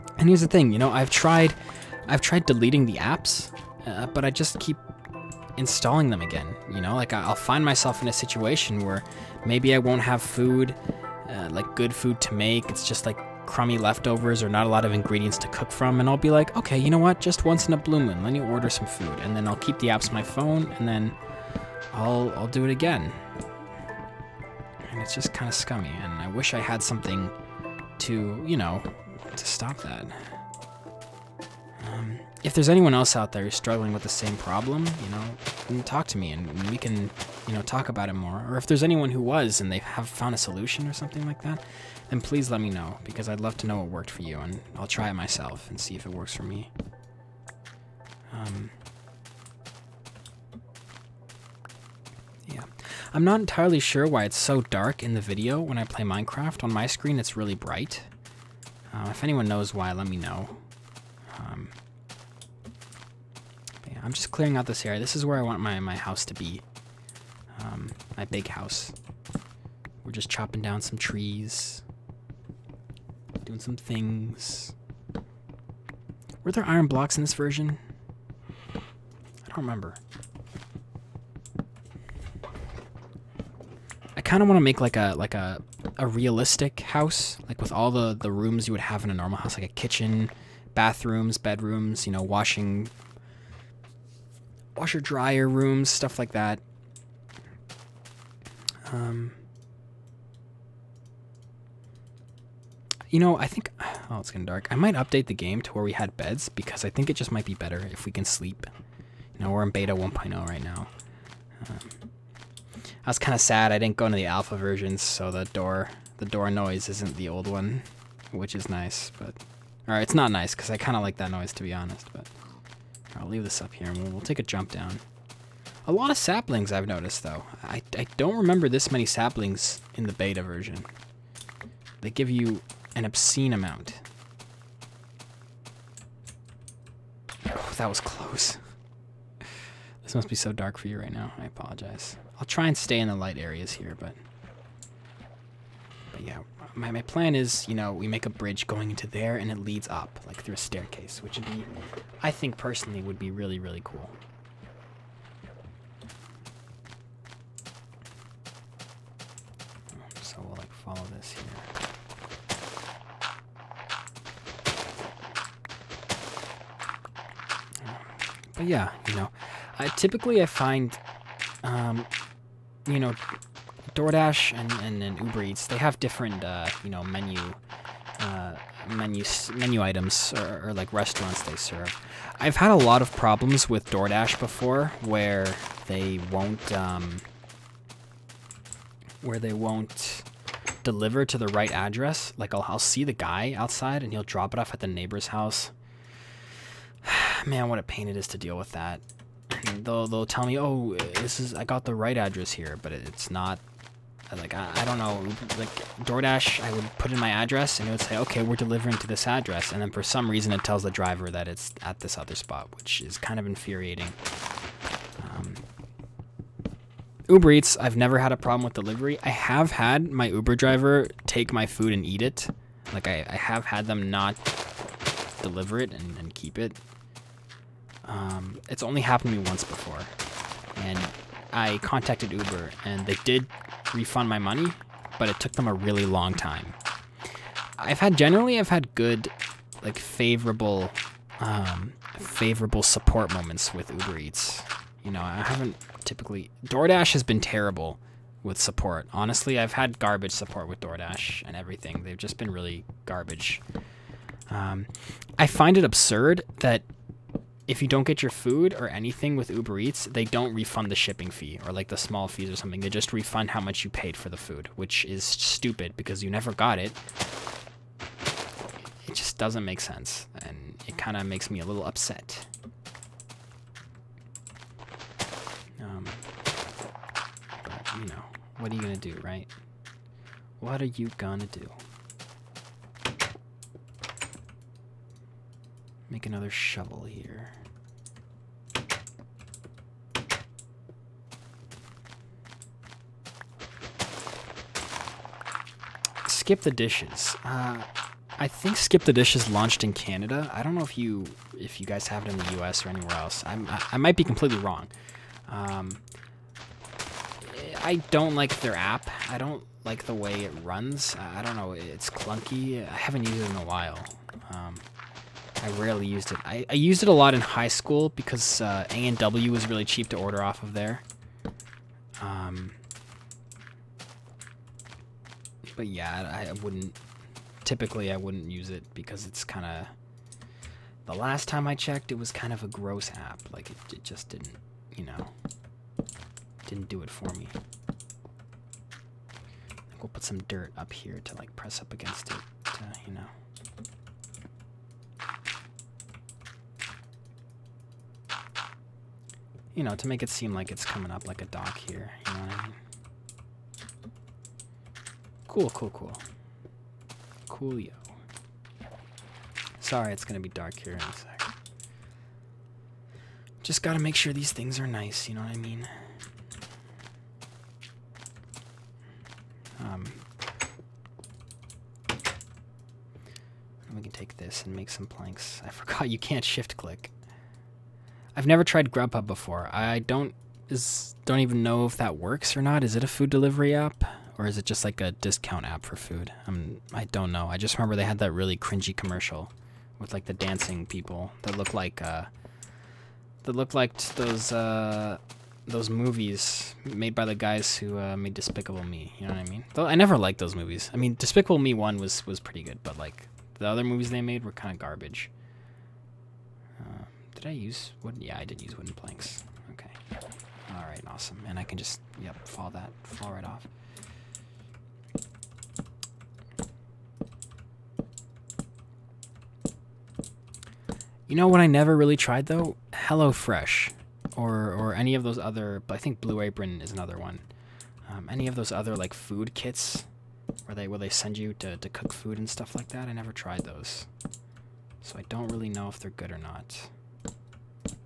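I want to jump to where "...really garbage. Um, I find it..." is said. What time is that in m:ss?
4:12.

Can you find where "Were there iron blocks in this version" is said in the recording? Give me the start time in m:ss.
1:16.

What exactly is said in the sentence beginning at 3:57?
I've had generally I've had good, like favorable, um, favorable support moments with Uber Eats.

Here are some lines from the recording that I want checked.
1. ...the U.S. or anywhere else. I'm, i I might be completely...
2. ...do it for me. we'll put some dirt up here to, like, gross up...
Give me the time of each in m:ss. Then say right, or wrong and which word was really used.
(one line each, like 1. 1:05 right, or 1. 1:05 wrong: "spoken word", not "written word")
1. 5:02 right
2. 5:36 wrong: "press", not "gross".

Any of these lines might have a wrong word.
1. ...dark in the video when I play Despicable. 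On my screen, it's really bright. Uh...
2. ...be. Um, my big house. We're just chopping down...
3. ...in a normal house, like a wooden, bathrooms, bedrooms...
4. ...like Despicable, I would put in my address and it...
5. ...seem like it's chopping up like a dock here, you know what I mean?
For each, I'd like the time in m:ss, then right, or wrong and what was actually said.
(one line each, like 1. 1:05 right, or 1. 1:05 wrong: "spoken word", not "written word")
1. 0:54 wrong: "Minecraft", not "Despicable"
2. 1:06 right
3. 1:29 wrong: "kitchen", not "wooden"
4. 3:25 wrong: "DoorDash", not "Despicable"
5. 5:50 wrong: "coming", not "chopping".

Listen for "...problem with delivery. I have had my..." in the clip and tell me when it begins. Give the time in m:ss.
3:38.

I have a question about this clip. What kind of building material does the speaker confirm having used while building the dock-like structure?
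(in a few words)
Wooden planks.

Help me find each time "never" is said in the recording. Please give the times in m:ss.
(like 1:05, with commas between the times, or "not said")
3:37, 4:26, 6:18, 6:39, 7:01, 7:13.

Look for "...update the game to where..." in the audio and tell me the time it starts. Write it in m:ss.
1:44.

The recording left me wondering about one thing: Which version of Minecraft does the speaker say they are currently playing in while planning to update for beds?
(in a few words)
Beta 1.0.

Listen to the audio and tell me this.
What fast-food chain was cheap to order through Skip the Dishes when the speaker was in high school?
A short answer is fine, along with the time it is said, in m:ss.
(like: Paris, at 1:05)
A&W, at 5:18.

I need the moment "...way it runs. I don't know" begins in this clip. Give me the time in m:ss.
5:10.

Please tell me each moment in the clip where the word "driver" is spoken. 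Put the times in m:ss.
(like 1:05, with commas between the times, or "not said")
3:30, 3:40.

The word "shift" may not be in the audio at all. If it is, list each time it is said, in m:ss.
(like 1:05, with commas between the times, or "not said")
6:16.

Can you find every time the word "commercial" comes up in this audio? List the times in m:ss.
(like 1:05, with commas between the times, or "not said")
6:28.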